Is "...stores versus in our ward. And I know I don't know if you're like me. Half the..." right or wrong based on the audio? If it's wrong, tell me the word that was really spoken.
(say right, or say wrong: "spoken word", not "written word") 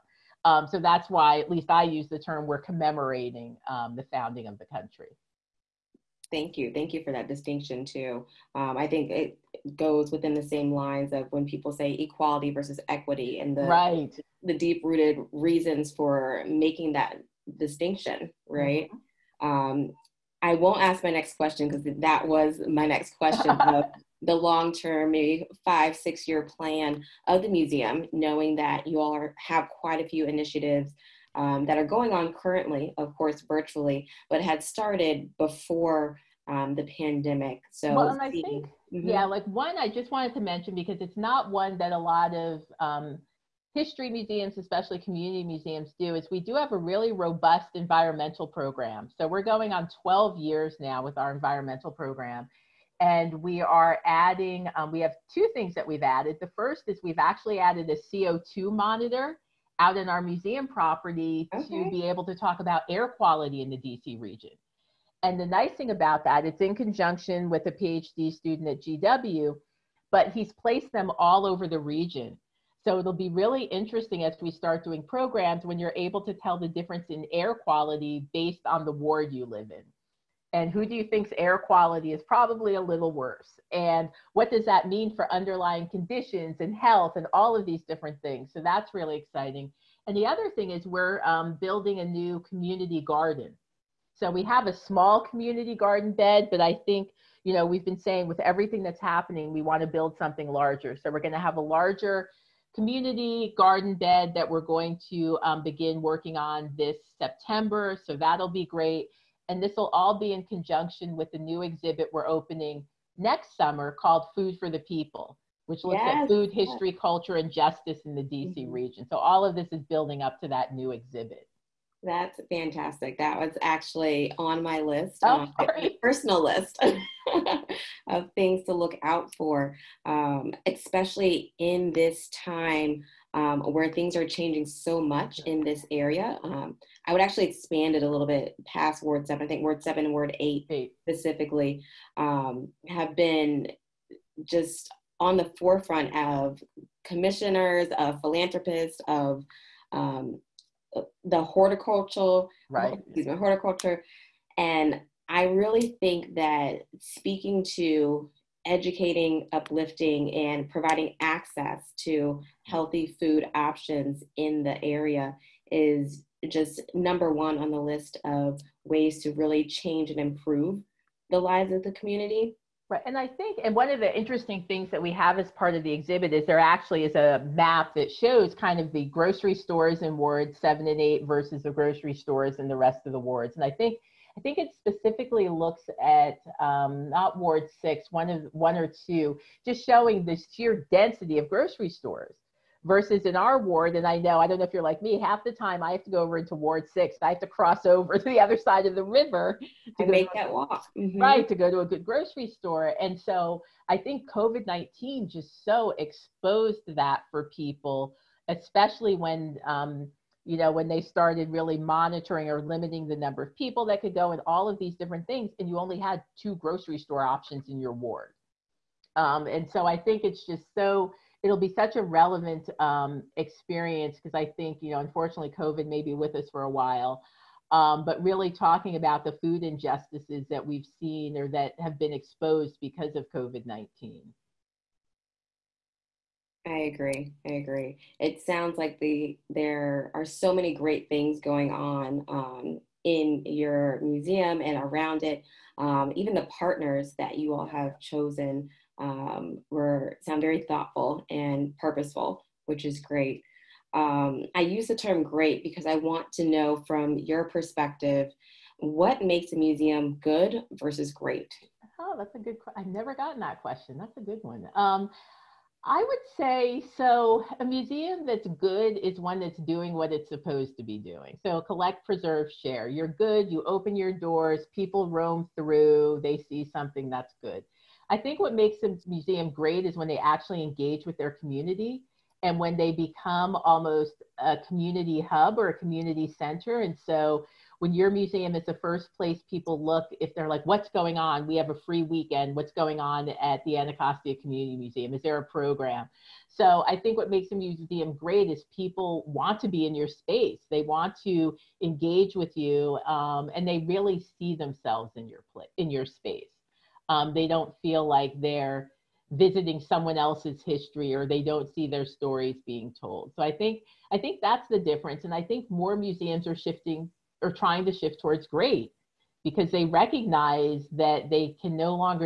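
right.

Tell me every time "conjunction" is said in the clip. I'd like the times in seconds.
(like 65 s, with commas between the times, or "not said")
66 s, 110 s.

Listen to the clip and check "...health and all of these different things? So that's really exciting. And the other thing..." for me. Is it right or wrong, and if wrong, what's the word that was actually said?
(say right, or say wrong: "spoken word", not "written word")
right.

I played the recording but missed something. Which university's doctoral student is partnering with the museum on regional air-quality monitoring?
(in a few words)
GW.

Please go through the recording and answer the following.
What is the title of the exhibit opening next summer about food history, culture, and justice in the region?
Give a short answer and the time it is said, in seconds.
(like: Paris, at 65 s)
Food for the People, at 114 s.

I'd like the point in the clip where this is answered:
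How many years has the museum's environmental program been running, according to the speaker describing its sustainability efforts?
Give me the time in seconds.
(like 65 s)
50 s.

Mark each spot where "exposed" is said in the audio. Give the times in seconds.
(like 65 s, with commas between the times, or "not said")
205 s, 232 s.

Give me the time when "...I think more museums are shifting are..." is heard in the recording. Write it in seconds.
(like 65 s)
315 s.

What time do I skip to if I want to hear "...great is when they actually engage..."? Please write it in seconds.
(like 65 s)
279 s.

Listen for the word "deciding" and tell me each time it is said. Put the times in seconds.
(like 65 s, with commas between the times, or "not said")
not said.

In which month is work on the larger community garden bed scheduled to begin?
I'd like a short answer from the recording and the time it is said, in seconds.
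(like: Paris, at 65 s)
September, at 107 s.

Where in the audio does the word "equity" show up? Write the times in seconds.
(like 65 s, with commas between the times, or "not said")
12 s.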